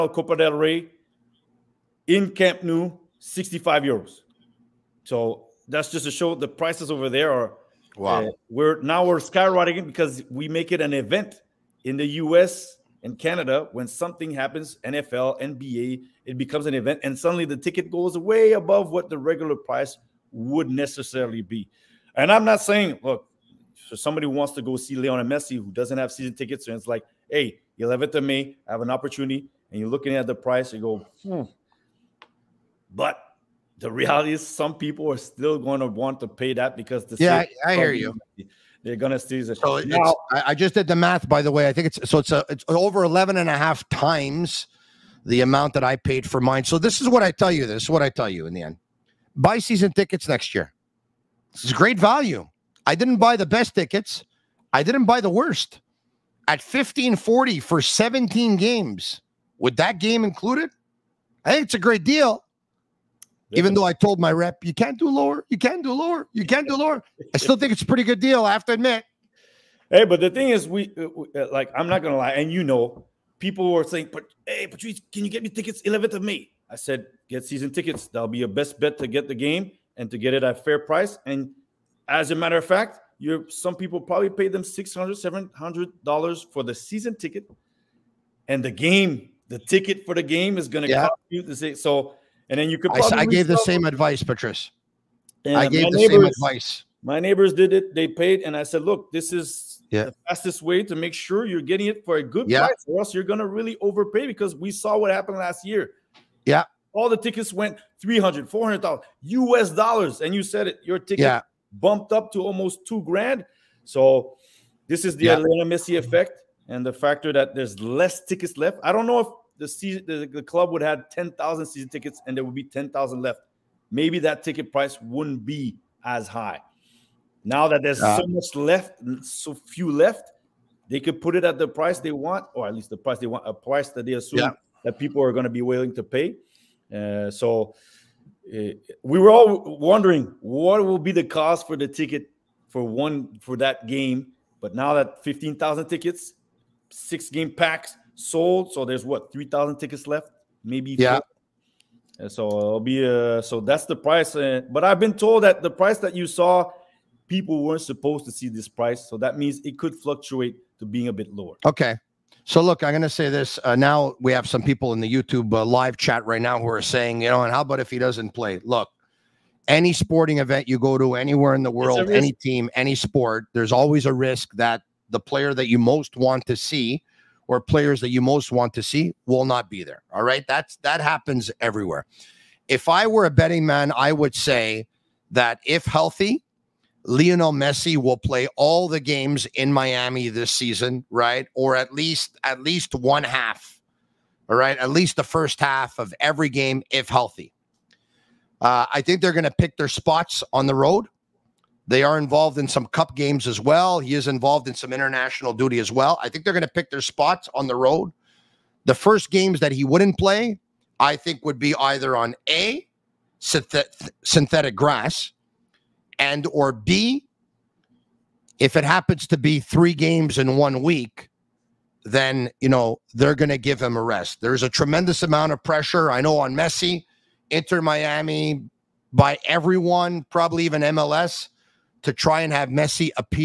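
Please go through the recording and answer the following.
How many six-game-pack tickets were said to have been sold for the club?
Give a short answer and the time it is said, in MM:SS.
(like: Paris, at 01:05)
15,000, at 02:25.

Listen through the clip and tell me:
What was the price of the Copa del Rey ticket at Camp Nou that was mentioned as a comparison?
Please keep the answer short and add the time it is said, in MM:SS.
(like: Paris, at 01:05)
65 euros, at 00:03.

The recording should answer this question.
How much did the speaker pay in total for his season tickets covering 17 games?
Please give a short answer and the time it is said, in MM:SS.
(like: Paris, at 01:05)
1540, at 00:56.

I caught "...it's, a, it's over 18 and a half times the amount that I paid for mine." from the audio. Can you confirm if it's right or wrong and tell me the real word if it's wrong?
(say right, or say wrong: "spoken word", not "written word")
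wrong: "11", not "18".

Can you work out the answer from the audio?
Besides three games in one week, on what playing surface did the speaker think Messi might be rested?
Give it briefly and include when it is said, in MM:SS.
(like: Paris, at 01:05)
synthetic grass, at 03:34.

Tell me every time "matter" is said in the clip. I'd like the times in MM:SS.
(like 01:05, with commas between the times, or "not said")
01:22.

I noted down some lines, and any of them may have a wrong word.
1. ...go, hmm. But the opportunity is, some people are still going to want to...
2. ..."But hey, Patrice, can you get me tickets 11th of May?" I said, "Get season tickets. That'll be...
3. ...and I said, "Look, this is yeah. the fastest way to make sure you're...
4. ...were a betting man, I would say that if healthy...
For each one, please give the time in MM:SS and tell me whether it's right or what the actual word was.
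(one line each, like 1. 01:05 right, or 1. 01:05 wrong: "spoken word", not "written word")
1. 00:30 wrong: "reality", not "opportunity"
2. 01:14 right
3. 01:38 right
4. 03:03 right.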